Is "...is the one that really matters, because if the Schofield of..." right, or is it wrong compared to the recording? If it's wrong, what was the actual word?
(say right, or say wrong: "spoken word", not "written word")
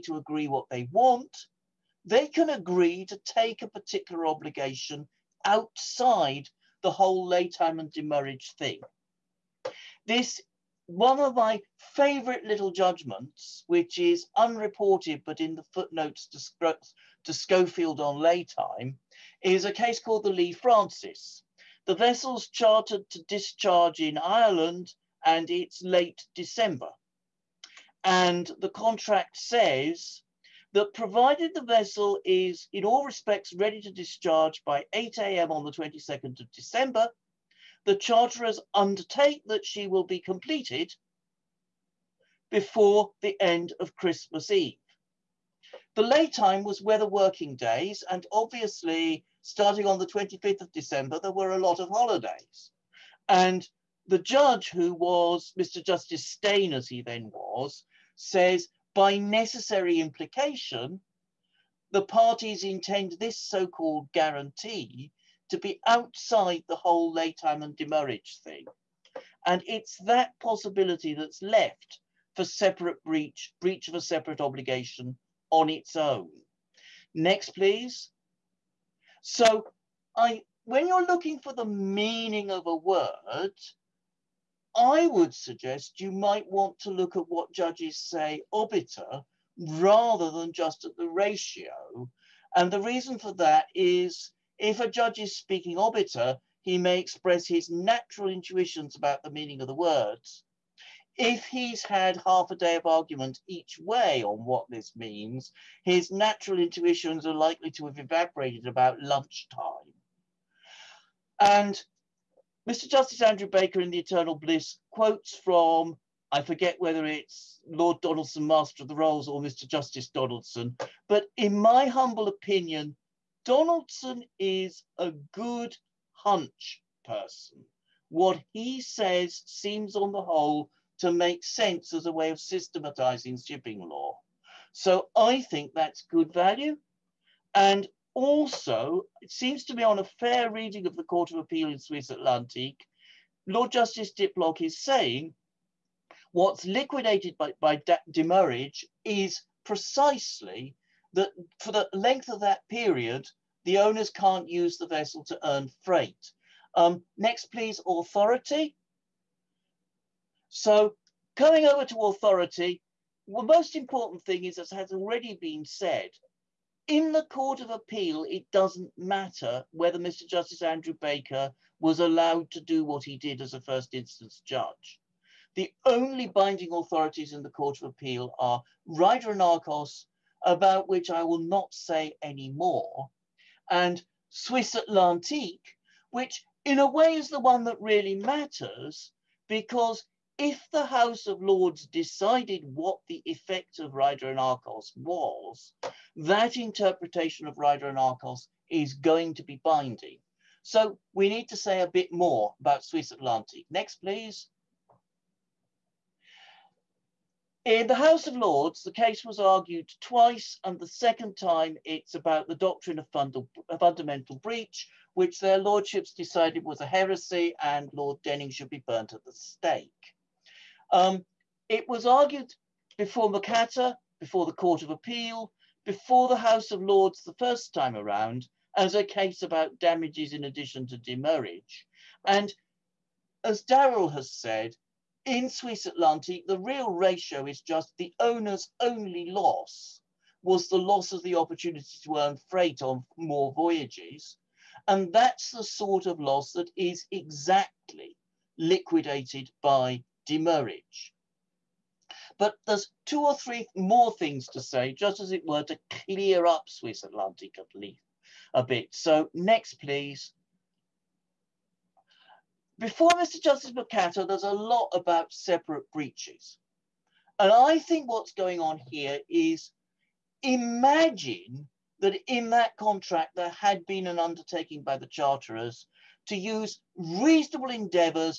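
wrong: "House", not "Schofield".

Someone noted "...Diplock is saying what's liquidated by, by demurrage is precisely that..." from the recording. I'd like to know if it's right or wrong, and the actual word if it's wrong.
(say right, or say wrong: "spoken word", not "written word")
right.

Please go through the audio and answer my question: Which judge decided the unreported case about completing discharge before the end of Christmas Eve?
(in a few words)
Mr. Justice Steyn.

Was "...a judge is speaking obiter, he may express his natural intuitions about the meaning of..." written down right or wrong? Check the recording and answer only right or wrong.
right.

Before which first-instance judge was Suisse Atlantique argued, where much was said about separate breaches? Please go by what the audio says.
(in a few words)
Mr. Justice Mocatta.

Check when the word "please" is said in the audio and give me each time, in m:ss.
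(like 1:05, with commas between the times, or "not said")
1:17, 2:37, 3:23, 4:19.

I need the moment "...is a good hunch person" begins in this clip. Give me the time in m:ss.
2:04.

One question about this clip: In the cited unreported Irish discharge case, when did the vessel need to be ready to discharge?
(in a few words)
8 a.m. on 22 December.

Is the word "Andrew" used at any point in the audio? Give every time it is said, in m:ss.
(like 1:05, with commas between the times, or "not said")
1:53, 2:50.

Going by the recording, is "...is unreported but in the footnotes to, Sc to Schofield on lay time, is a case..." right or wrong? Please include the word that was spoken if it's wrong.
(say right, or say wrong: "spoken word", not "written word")
right.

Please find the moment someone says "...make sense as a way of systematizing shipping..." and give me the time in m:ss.
2:11.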